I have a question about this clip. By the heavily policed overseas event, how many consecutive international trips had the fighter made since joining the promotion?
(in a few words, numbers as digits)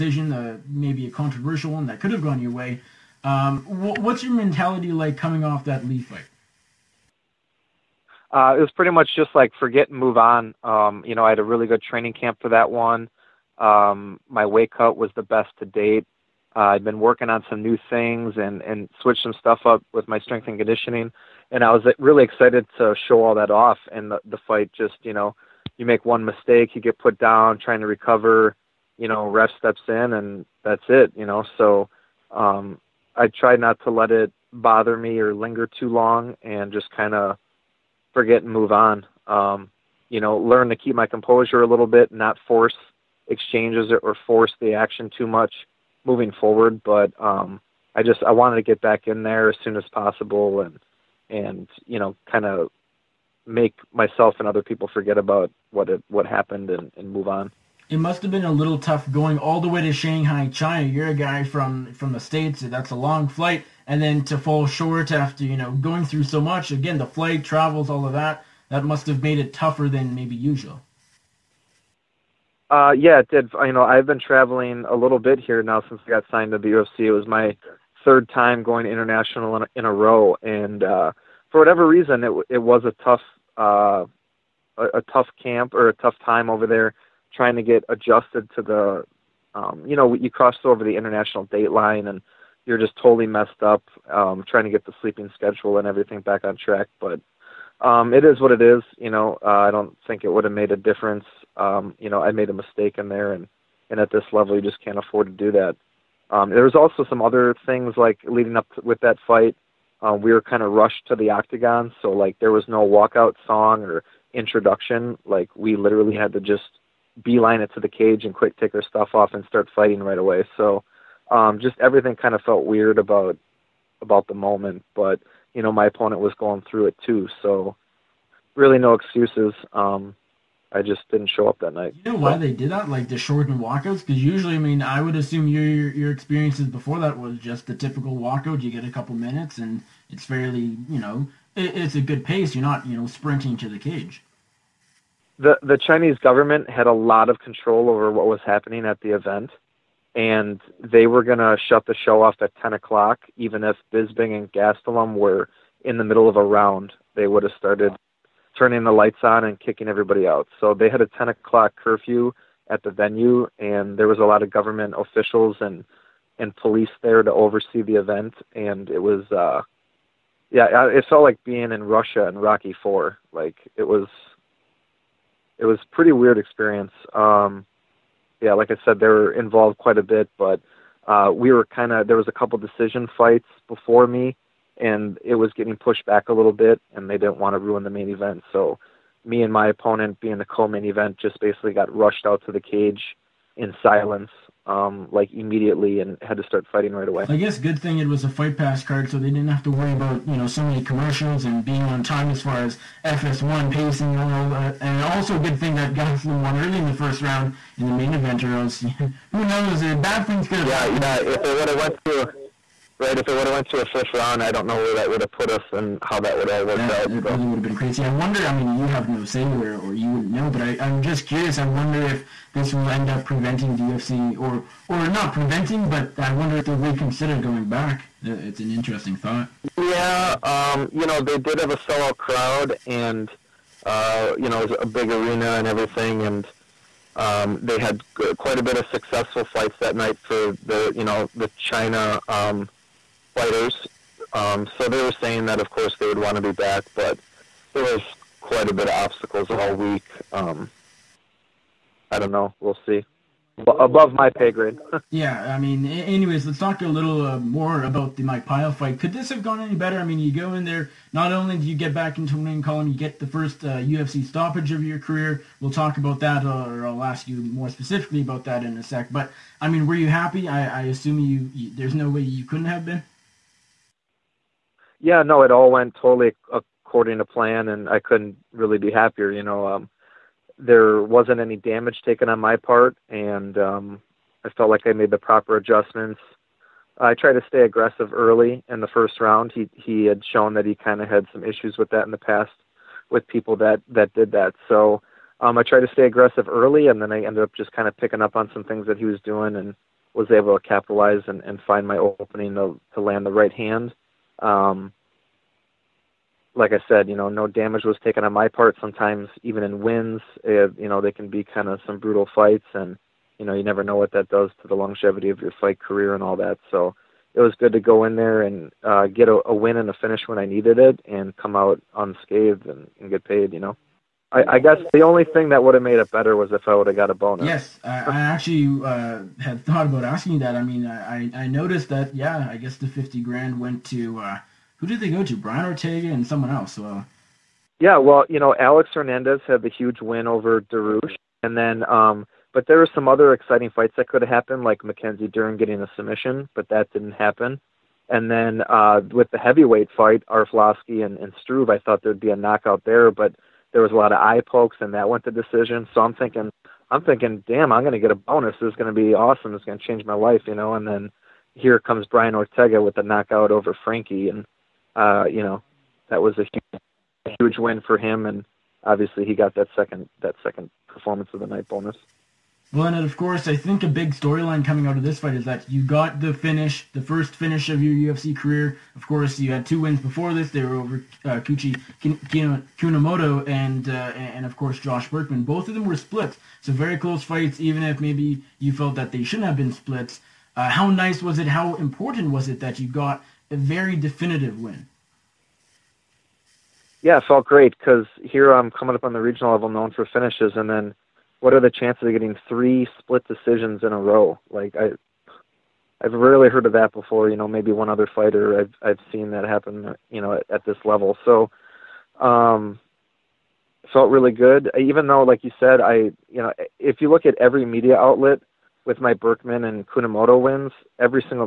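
3.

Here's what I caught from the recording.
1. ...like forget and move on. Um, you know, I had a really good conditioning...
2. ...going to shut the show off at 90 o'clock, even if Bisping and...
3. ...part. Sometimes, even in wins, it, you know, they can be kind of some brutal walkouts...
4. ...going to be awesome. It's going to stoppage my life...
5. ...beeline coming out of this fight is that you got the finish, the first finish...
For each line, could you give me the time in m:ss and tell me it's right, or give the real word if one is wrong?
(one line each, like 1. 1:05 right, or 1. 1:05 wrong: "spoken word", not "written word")
1. 0:09 wrong: "training", not "conditioning"
2. 2:31 wrong: "10", not "90"
3. 5:08 wrong: "fights", not "walkouts"
4. 5:58 wrong: "change", not "stoppage"
5. 6:14 wrong: "storyline", not "beeline".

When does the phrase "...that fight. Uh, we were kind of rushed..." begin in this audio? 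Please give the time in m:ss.
1:48.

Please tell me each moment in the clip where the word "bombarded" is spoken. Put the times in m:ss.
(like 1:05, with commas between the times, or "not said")
not said.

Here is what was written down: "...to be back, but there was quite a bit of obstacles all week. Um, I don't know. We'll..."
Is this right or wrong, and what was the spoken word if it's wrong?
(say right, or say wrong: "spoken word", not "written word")
right.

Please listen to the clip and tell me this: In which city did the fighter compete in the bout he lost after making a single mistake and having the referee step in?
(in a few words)
Shanghai.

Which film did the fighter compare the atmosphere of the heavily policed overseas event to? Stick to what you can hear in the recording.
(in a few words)
Rocky Four.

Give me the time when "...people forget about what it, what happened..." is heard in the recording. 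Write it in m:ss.
0:54.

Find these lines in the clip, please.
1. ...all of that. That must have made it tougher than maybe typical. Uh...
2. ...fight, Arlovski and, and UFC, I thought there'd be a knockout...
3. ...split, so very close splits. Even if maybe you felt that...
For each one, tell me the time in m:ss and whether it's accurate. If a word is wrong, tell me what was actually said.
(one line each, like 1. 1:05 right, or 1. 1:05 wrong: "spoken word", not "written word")
1. 1:07 wrong: "usual", not "typical"
2. 5:49 wrong: "Struve", not "UFC"
3. 6:25 wrong: "fights", not "splits".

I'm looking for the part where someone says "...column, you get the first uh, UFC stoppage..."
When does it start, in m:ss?
4:22.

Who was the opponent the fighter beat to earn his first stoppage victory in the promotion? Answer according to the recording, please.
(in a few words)
Mike Pyle.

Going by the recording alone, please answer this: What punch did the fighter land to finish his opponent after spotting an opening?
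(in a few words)
Right hand.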